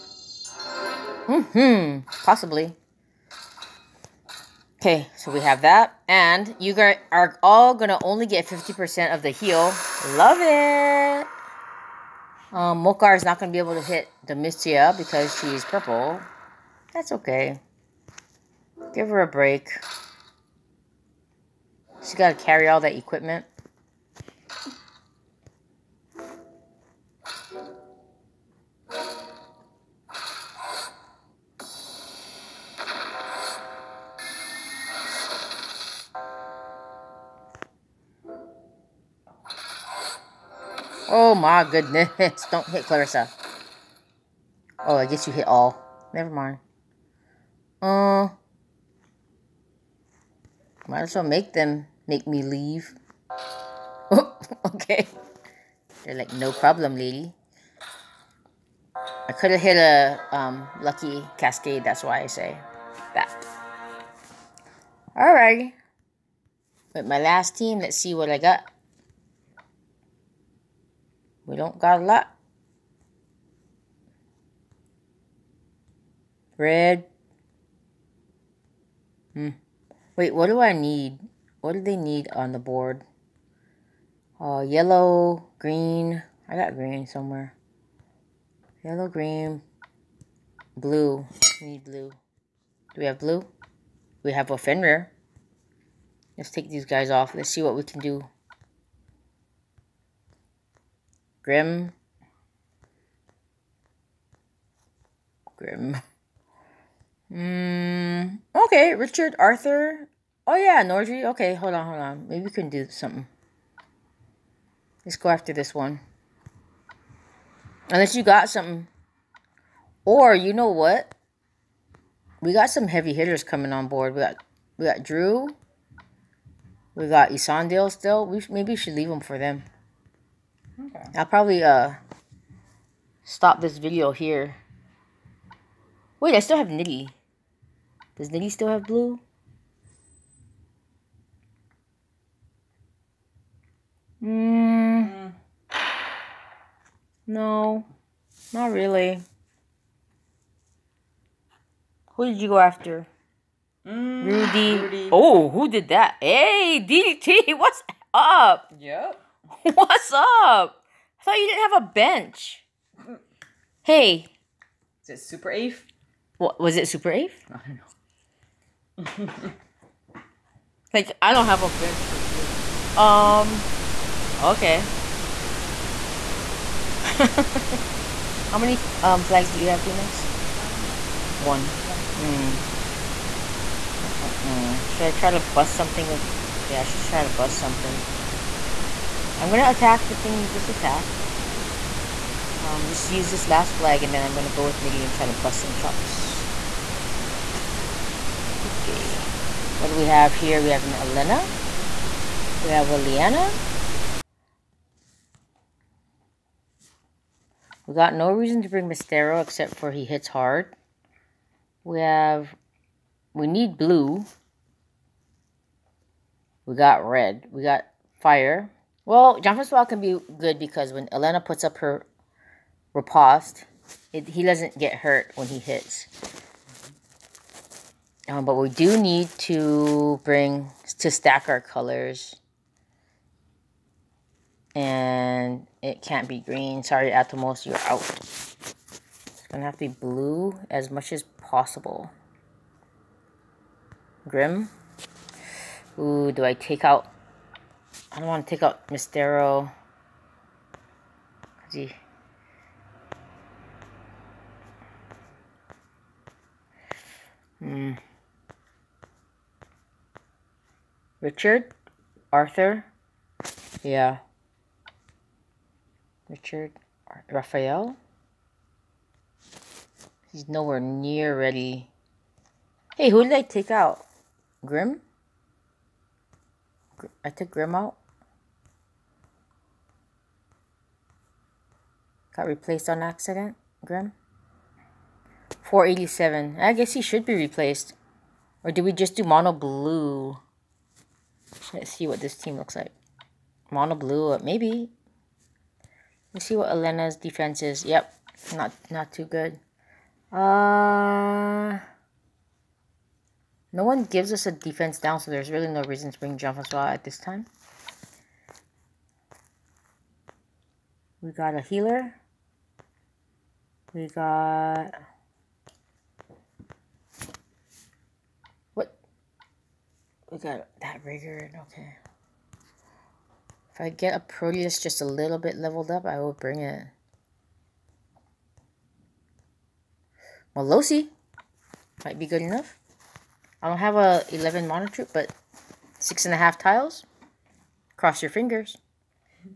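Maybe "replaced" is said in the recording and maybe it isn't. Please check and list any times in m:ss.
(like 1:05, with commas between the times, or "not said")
4:42, 4:47.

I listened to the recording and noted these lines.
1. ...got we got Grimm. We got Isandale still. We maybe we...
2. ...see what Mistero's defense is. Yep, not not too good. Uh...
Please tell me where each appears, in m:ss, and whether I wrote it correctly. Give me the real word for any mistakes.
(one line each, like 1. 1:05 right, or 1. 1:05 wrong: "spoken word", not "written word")
1. 2:04 wrong: "Drew", not "Grimm"
2. 4:56 wrong: "Elena", not "Mistero".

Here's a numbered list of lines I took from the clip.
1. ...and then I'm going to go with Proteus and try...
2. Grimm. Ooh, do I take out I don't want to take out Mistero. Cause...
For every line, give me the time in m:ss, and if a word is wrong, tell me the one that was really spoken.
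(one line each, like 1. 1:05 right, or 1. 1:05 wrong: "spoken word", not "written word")
1. 3:14 wrong: "Niddy", not "Proteus"
2. 4:04 right.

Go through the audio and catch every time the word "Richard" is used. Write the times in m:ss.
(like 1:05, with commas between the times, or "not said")
1:48, 4:21, 4:26.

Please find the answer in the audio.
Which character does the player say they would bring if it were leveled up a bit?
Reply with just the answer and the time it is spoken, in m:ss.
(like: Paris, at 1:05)
Proteus, at 5:24.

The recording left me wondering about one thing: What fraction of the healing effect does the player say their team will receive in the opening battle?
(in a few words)
50%.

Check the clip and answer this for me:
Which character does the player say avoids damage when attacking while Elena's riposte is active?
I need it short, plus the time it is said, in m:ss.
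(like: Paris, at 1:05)
Jean Francois, at 3:39.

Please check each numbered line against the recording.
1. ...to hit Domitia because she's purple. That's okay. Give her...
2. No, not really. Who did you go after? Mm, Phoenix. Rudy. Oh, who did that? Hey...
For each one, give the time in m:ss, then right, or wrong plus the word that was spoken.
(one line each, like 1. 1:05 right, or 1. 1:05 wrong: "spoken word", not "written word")
1. 0:13 right
2. 2:27 wrong: "Rudy", not "Phoenix".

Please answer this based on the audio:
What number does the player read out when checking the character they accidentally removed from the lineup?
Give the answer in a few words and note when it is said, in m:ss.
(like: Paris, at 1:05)
487, at 4:45.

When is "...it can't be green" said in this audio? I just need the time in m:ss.
3:55.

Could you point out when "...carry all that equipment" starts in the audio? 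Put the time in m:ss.
0:22.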